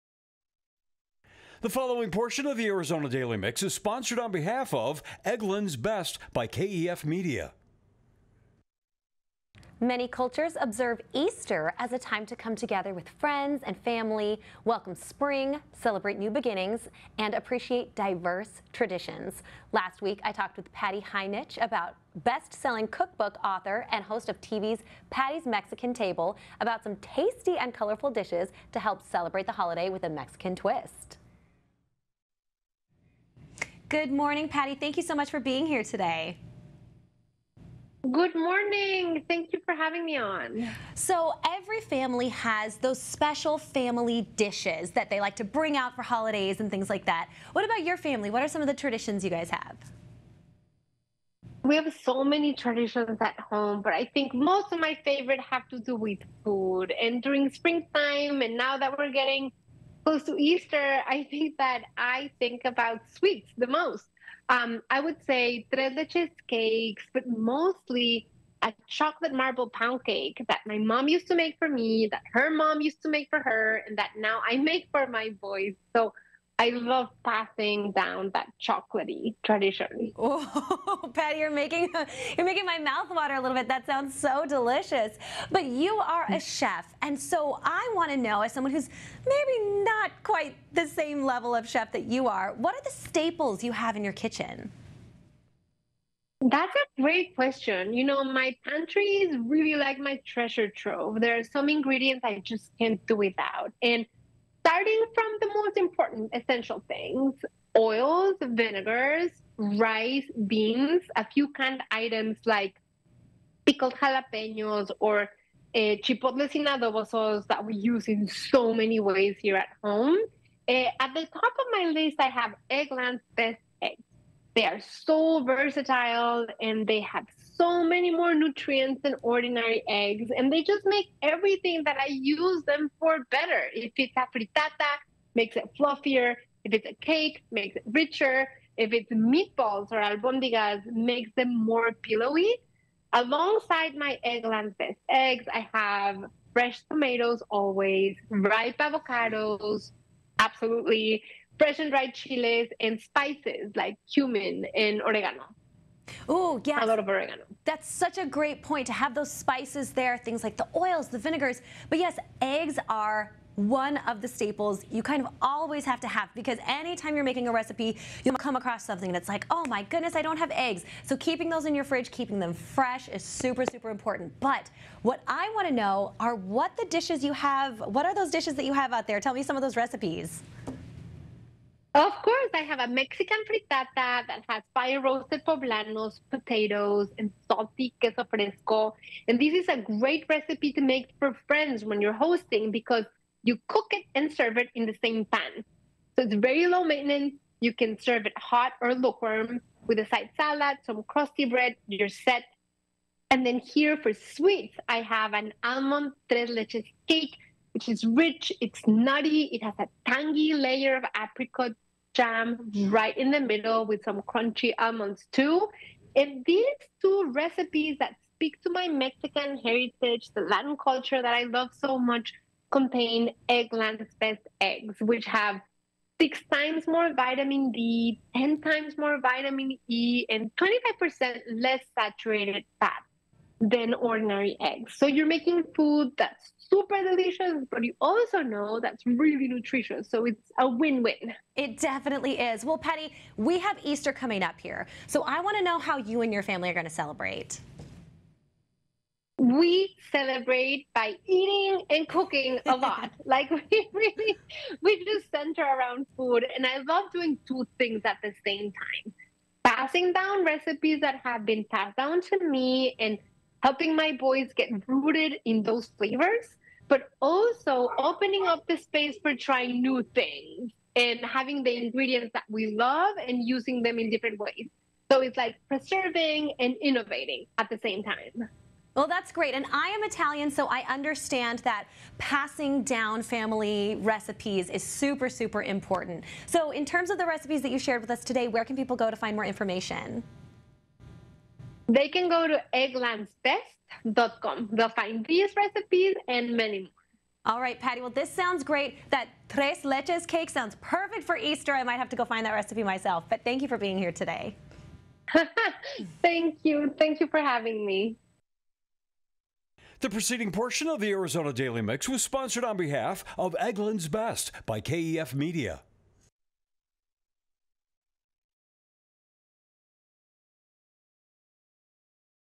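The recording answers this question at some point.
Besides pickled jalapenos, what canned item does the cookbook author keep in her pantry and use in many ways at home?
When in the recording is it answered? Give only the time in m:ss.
1:56.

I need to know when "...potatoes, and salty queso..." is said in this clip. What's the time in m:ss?
3:06.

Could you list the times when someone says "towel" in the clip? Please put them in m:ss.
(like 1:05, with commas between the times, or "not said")
not said.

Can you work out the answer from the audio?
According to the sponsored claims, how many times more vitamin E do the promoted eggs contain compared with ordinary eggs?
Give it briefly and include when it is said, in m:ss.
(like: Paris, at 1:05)
10, at 3:48.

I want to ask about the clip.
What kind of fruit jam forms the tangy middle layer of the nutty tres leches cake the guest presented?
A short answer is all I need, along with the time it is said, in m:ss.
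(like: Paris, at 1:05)
apricot, at 3:31.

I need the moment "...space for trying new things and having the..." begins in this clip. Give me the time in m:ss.
4:28.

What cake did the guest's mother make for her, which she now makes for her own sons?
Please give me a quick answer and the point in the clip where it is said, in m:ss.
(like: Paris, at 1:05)
chocolate marble pound cake, at 1:08.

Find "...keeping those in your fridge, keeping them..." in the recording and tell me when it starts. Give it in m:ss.
2:51.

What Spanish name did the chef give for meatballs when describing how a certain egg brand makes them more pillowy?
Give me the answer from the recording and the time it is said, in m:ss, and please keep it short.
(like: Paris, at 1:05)
albondigas, at 2:20.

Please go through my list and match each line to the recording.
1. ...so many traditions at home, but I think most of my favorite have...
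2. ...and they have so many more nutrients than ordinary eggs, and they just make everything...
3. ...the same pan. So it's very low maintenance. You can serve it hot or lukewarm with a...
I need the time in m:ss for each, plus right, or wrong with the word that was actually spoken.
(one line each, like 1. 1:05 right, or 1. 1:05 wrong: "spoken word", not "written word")
1. 0:51 right
2. 2:06 right
3. 3:14 right.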